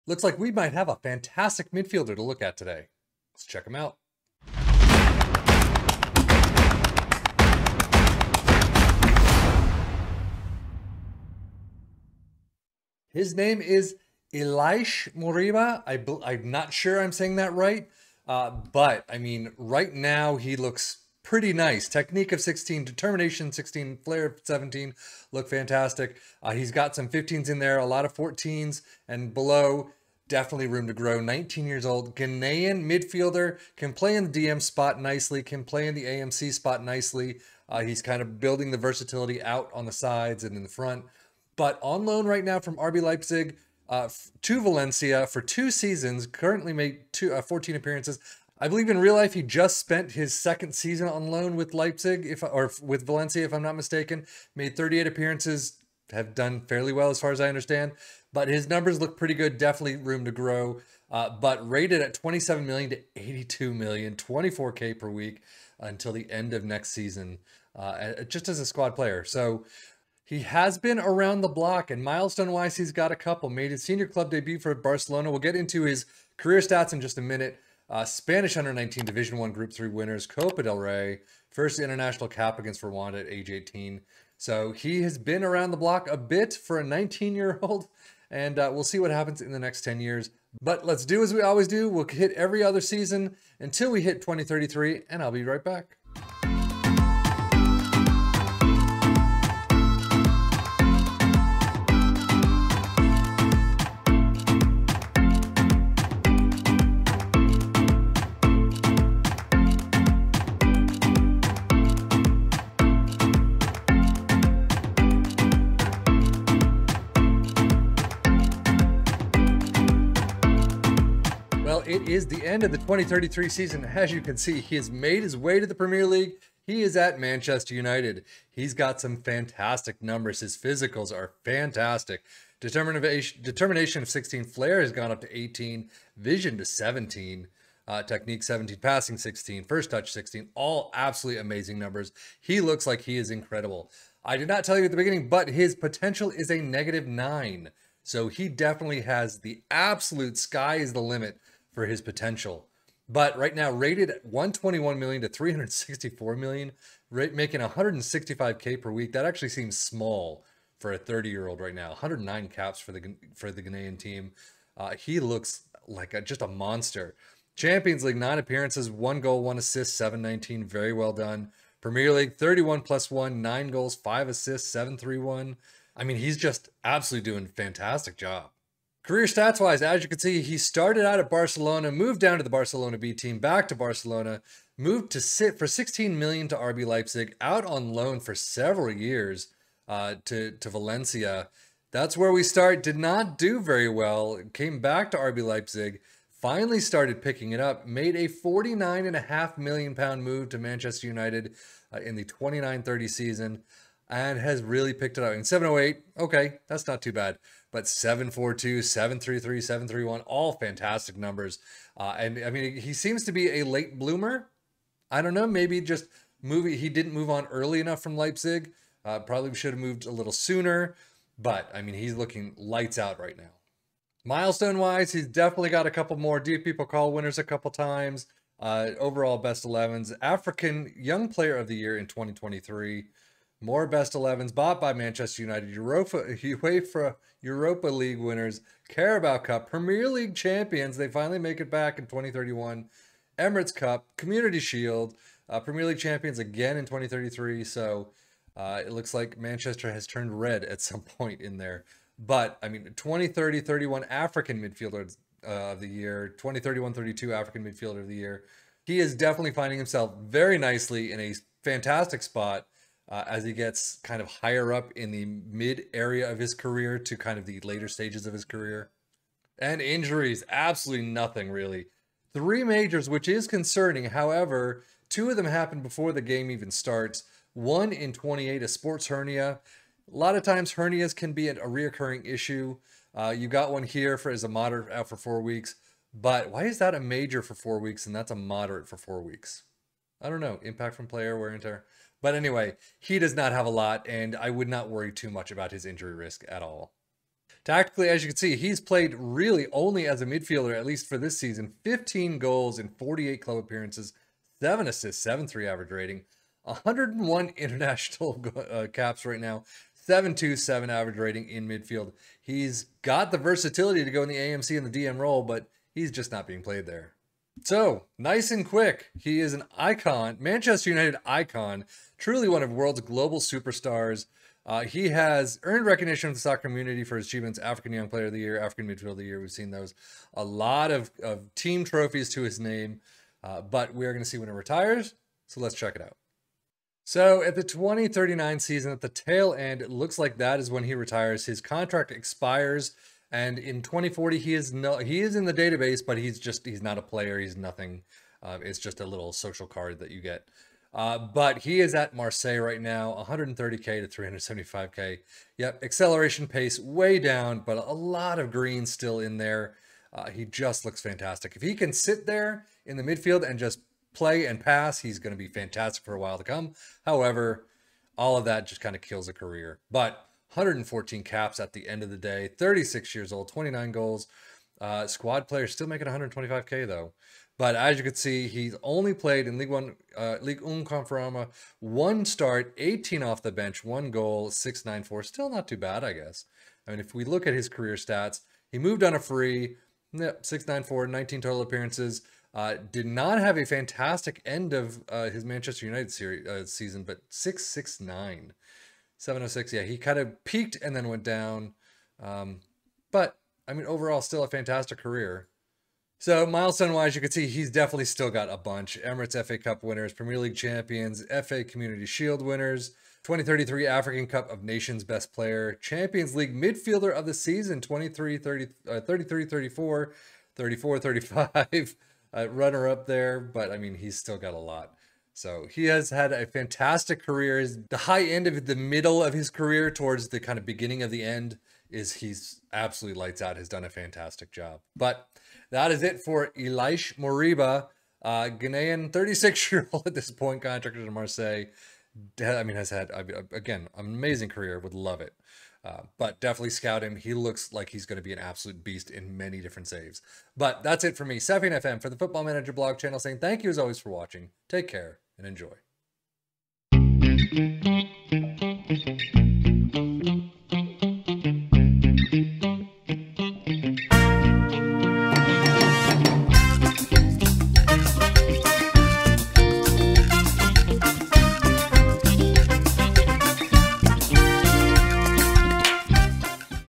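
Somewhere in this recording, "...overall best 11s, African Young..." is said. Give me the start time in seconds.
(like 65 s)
228 s.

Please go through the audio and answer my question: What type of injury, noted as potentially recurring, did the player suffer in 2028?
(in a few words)
Sports hernia.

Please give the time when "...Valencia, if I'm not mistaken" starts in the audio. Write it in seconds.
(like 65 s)
53 s.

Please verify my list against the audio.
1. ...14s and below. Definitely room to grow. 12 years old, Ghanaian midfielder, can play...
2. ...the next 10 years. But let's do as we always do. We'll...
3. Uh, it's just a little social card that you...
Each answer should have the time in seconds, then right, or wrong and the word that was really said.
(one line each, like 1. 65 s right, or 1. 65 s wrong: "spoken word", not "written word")
1. 28 s wrong: "19", not "12"
2. 89 s right
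3. 348 s right.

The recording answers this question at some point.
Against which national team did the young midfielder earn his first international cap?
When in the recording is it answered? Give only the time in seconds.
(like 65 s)
82 s.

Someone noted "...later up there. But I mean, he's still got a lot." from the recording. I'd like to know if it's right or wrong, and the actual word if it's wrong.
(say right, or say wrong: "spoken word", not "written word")
wrong: "runner", not "later".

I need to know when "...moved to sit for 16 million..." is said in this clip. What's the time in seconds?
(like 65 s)
184 s.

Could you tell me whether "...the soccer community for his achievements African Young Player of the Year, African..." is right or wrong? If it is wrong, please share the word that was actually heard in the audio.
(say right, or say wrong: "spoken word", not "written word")
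right.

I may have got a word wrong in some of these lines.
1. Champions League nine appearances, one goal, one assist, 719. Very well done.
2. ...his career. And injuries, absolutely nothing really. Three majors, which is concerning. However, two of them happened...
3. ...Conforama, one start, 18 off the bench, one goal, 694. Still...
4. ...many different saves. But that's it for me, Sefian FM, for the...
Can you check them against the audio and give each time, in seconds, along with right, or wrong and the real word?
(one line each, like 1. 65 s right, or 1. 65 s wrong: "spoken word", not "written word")
1. 167 s right
2. 268 s right
3. 380 s right
4. 449 s right.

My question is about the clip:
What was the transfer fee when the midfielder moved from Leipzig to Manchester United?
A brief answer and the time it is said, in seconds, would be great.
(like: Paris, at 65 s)
49.5 million pounds, at 198 s.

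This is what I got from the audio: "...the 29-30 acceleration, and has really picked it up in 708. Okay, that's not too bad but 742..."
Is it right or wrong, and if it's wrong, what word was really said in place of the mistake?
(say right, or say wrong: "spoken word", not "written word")
wrong: "season", not "acceleration".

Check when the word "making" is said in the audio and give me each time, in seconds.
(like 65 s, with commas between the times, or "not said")
157 s, 375 s.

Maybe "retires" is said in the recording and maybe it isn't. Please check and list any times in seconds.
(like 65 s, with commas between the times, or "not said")
334 s, 340 s.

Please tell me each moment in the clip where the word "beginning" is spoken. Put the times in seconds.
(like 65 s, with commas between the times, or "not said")
144 s, 430 s.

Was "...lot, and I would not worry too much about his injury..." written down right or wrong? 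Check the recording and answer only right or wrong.
right.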